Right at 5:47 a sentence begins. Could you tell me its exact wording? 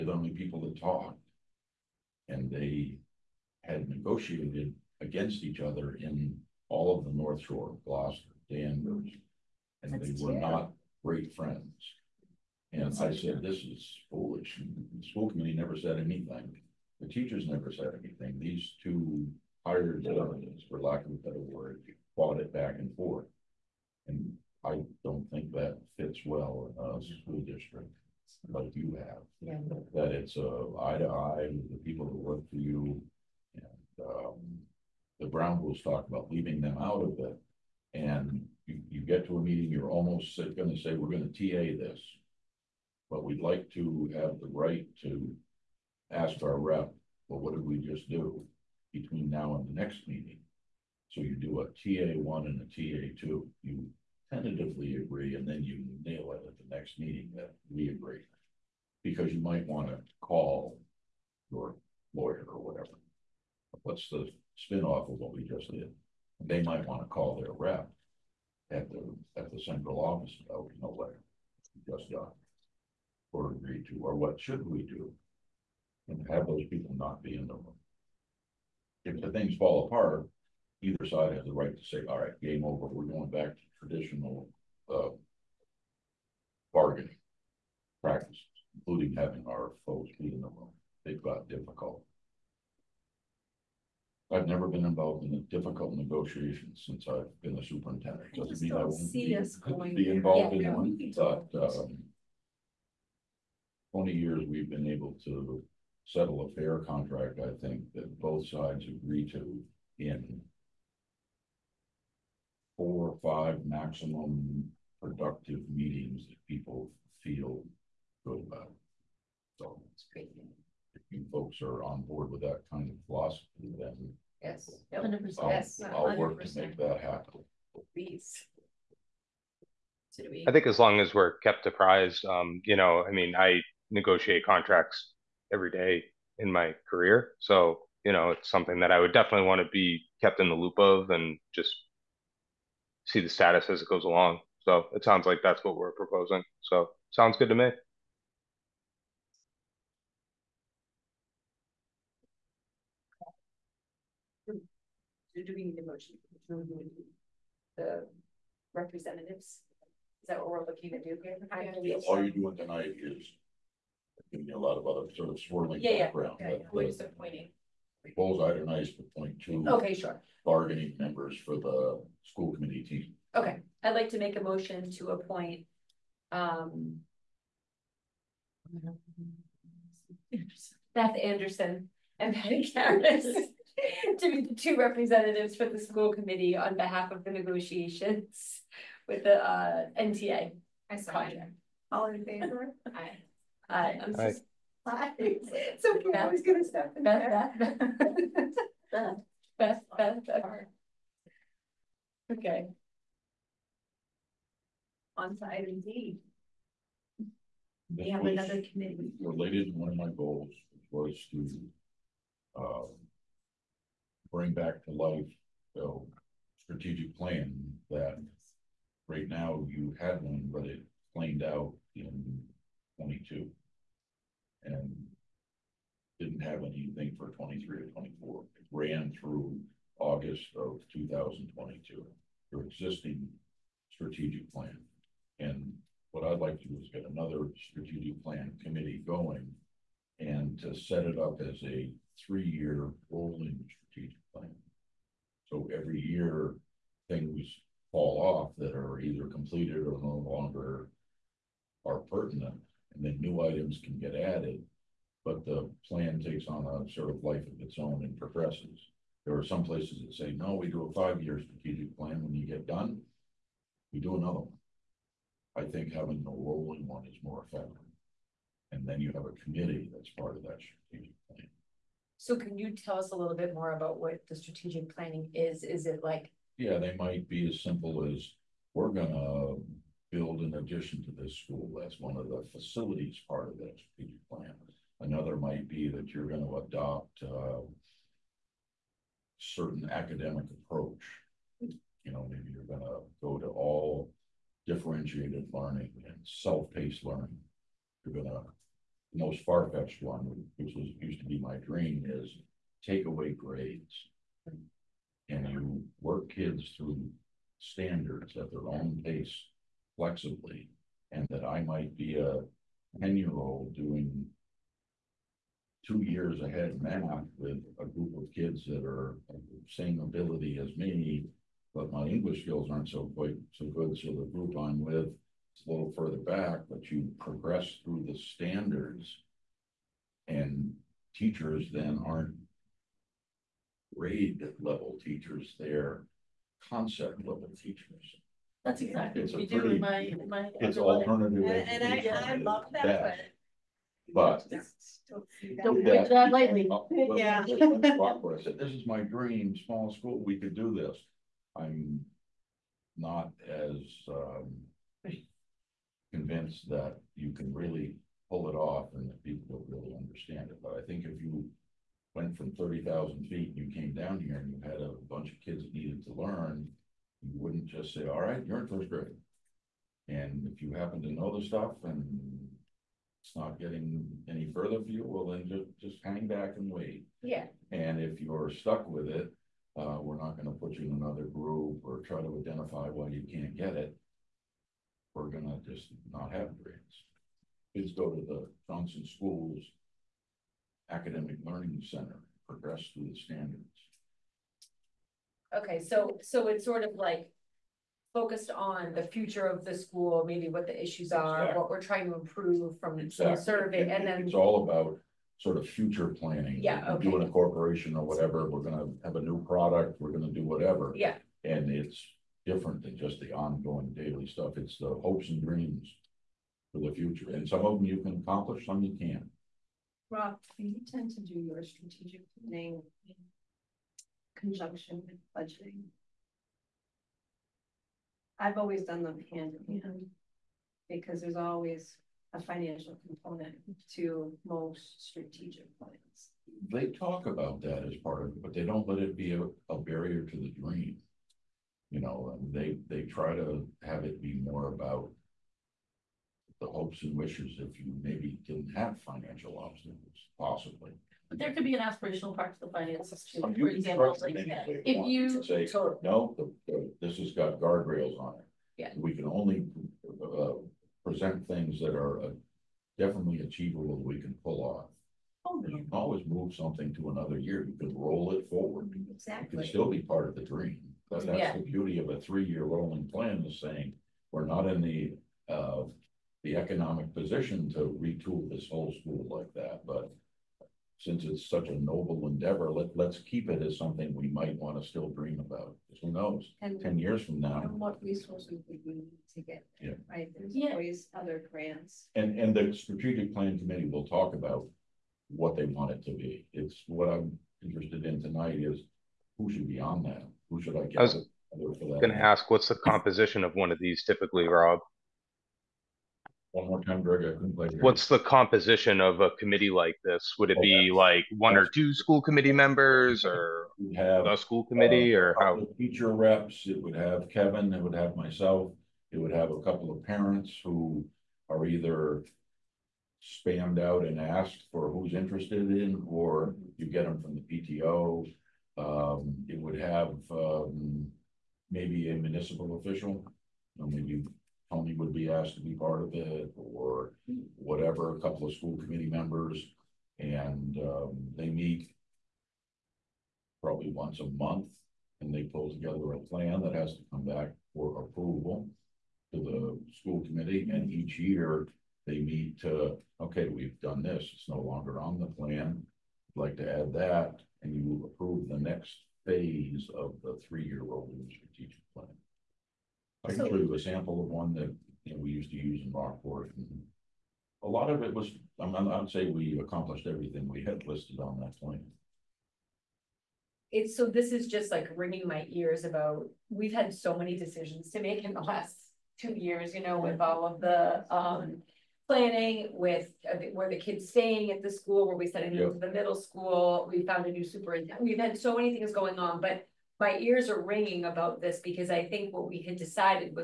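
This is my dream, small school, we could do this.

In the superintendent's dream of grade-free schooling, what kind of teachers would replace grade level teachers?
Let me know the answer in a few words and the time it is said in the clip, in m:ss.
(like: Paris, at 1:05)
Concept level teachers, at 5:36.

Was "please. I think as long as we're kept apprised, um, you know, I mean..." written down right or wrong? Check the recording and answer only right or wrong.
right.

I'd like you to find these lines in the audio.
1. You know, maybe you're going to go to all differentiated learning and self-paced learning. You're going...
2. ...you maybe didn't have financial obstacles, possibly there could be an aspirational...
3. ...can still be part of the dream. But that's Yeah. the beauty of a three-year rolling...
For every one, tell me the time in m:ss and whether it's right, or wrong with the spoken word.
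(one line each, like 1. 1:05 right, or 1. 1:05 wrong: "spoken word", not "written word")
1. 4:51 right
2. 7:27 right
3. 7:49 right.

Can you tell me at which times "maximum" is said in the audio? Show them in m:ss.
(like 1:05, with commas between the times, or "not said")
1:53.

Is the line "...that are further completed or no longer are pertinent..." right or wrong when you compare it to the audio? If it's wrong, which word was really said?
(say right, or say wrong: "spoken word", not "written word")
wrong: "either", not "further".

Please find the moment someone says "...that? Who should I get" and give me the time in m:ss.
8:20.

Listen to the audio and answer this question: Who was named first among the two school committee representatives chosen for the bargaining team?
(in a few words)
Beth Anderson.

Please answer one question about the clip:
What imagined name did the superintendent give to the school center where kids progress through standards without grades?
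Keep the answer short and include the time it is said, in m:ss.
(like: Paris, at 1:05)
Johnson Schools Academic Learning Center, at 6:28.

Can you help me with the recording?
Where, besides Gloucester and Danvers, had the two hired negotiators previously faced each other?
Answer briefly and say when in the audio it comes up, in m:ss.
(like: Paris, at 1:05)
North Shore, at 0:07.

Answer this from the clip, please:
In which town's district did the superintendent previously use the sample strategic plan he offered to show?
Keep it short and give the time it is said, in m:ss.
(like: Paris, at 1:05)
Rockport, at 9:25.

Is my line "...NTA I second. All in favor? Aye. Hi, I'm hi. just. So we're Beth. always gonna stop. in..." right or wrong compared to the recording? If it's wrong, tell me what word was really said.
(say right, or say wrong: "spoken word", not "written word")
right.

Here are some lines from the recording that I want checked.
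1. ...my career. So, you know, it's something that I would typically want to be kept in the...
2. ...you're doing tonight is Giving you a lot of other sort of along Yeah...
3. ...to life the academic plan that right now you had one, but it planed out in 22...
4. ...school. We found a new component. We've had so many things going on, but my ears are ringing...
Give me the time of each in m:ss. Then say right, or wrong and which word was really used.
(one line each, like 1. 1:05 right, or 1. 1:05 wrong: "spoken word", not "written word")
1. 2:16 wrong: "definitely", not "typically"
2. 2:42 wrong: "swirling", not "along"
3. 3:34 wrong: "strategic", not "academic"
4. 9:46 wrong: "superintendent", not "component".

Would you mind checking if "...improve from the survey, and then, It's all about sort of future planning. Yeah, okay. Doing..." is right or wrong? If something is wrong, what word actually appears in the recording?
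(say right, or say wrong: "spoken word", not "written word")
right.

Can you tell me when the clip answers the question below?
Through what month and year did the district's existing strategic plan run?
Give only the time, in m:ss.
3:49.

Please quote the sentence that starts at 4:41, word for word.
That's one of the facilities part of that strategic plan.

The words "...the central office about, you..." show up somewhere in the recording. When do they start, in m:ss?
1:09.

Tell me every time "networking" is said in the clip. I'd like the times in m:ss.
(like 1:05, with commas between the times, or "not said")
not said.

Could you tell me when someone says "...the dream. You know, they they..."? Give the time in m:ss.
7:20.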